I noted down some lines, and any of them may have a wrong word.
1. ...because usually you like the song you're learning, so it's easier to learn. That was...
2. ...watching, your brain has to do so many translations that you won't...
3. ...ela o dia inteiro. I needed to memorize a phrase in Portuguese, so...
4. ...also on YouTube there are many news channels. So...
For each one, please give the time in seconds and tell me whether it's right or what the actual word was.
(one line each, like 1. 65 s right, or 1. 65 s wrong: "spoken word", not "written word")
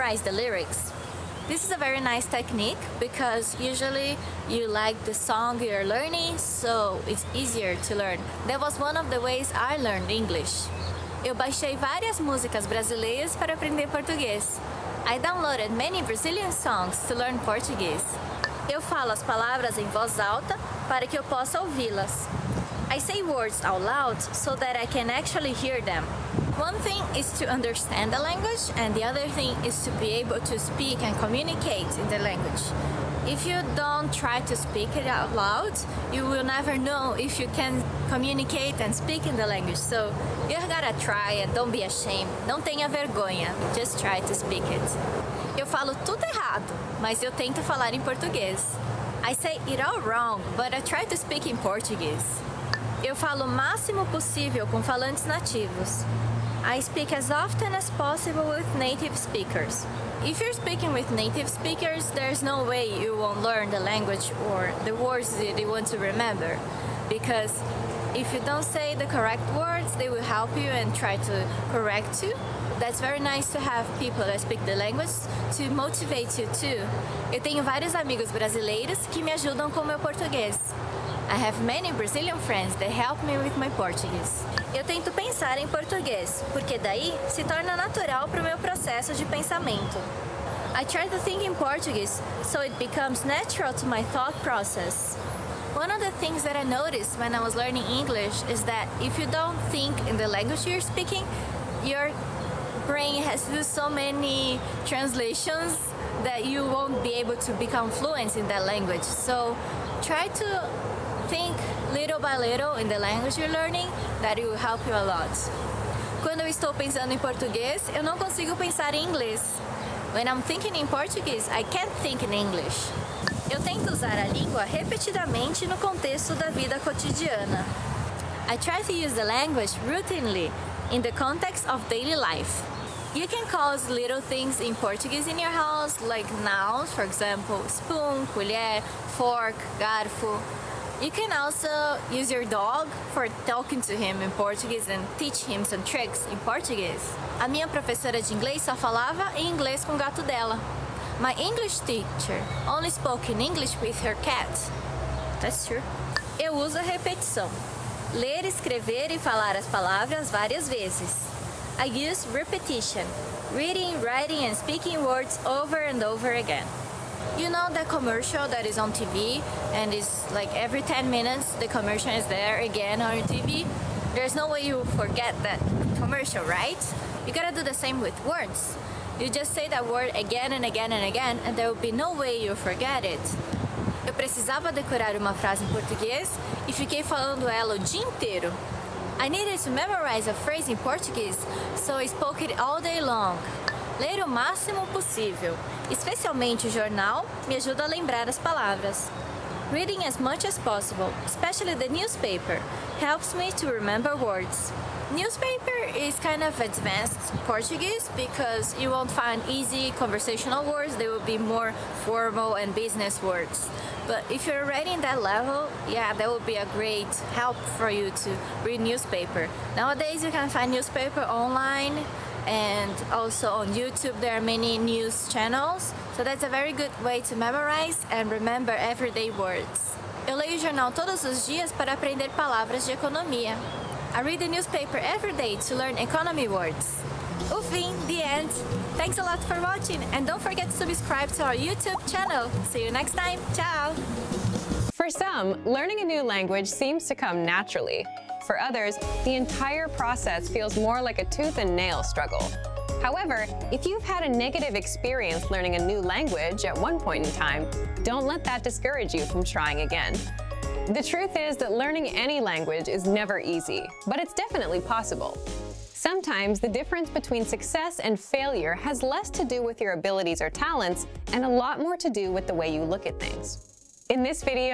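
1. 2 s right
2. 100 s wrong: "speaking", not "watching"
3. 187 s right
4. 223 s right.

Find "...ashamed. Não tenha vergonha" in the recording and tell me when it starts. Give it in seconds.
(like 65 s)
41 s.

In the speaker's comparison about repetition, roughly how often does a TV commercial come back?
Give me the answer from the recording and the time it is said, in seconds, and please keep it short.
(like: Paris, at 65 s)
Every 10 minutes, at 170 s.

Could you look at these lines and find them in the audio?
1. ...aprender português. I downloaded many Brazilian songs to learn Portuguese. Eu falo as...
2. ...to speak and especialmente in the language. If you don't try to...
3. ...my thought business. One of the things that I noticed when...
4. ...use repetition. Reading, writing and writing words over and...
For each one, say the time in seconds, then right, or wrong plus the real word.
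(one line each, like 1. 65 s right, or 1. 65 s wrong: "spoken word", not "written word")
1. 13 s right
2. 30 s wrong: "communicate", not "especialmente"
3. 93 s wrong: "process", not "business"
4. 161 s wrong: "speaking", not "writing".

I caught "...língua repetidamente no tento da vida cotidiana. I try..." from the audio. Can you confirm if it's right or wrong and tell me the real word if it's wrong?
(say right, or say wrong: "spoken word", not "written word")
wrong: "contexto", not "tento".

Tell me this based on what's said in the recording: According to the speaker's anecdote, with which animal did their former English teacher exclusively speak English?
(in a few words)
Her cat.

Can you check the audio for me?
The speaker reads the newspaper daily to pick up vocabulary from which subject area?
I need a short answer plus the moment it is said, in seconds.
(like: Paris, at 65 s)
Economy, at 232 s.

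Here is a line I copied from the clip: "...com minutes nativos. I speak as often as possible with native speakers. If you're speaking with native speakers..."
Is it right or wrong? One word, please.
wrong.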